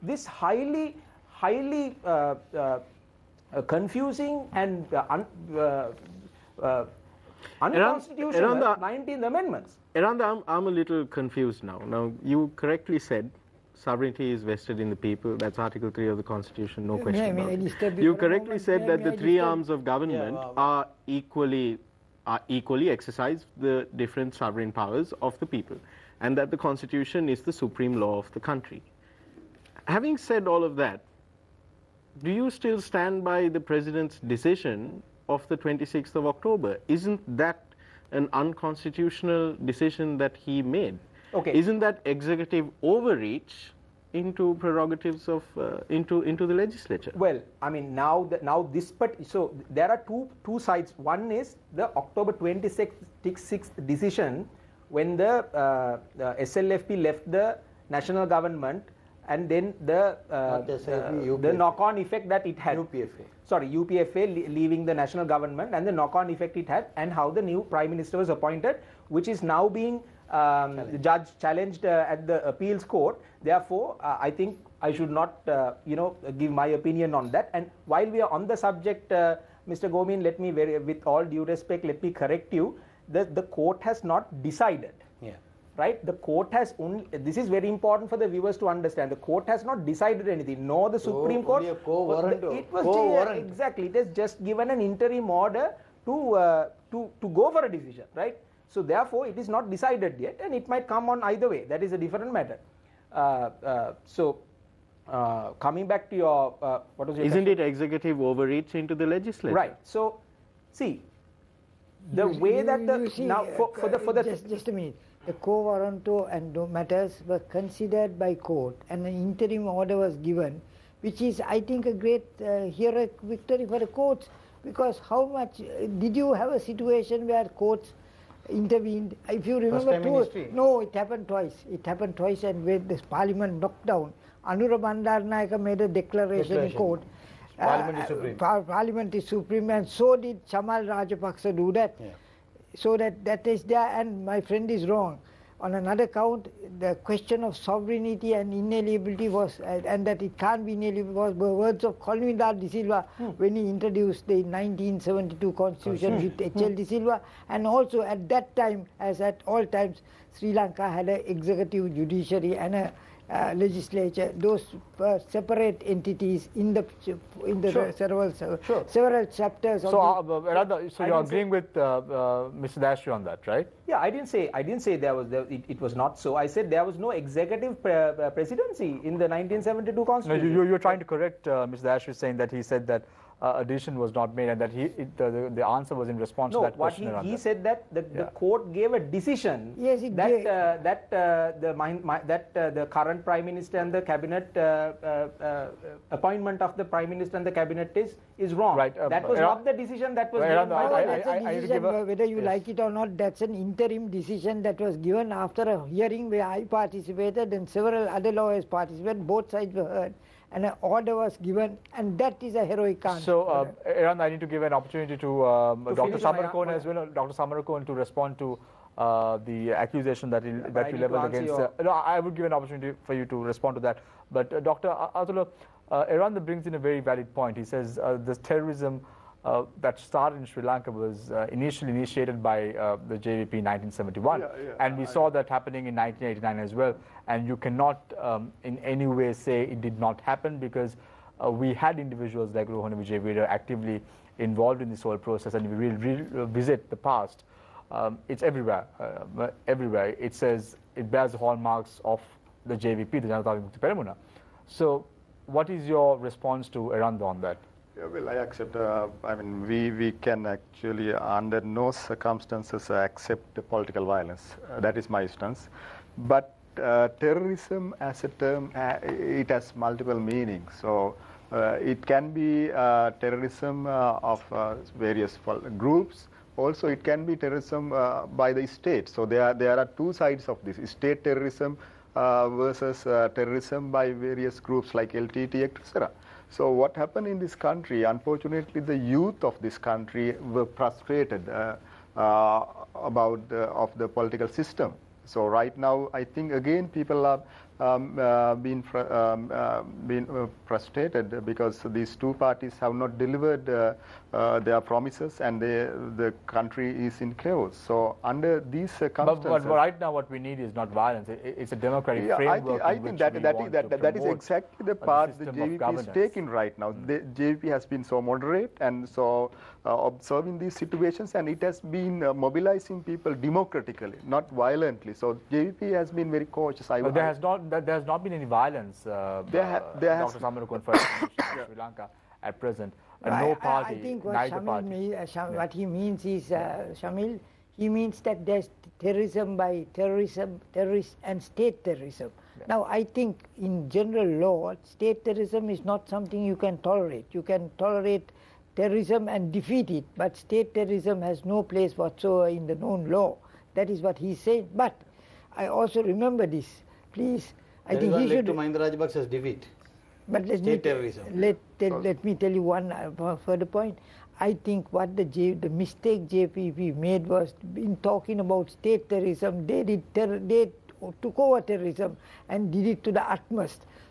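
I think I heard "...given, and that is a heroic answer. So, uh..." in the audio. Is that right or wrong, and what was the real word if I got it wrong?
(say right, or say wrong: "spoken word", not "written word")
right.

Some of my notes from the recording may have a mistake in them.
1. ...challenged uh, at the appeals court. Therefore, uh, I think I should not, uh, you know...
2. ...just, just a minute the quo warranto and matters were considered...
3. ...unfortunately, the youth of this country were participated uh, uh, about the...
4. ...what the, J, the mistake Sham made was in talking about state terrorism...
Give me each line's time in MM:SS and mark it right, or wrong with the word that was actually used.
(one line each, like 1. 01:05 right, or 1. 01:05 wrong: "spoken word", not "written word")
1. 01:11 right
2. 01:54 right
3. 04:48 wrong: "frustrated", not "participated"
4. 06:04 wrong: "JPP", not "Sham".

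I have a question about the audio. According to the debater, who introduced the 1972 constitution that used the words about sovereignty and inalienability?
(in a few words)
Colvin R. de Silva.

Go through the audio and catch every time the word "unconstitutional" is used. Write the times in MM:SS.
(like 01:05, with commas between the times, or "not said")
00:07, 00:38.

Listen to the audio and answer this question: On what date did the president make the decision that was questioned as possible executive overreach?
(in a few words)
26th of October.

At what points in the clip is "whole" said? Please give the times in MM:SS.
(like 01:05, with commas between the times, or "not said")
04:05.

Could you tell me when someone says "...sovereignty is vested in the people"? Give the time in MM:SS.
00:13.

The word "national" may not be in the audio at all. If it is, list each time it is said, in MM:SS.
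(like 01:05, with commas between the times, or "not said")
00:57, 01:04.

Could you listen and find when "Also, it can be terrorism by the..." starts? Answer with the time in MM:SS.
04:36.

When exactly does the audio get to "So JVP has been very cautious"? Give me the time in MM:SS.
05:25.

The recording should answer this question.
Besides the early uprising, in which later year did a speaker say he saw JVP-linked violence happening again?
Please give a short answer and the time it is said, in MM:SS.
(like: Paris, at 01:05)
1989, at 03:55.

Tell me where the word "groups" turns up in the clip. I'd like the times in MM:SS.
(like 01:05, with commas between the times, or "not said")
04:35, 04:44.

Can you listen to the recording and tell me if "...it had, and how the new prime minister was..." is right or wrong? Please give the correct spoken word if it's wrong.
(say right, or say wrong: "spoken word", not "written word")
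right.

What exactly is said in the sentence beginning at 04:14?
So, what is your response to Eranda on that?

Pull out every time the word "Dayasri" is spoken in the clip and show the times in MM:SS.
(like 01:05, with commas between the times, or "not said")
02:52, 03:01.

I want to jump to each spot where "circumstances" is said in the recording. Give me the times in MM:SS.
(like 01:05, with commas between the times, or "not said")
04:21, 05:08.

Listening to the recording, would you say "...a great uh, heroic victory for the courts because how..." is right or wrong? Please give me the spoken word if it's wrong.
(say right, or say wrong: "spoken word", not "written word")
right.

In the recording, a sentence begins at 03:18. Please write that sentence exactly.
Um, that was not the decision that was given.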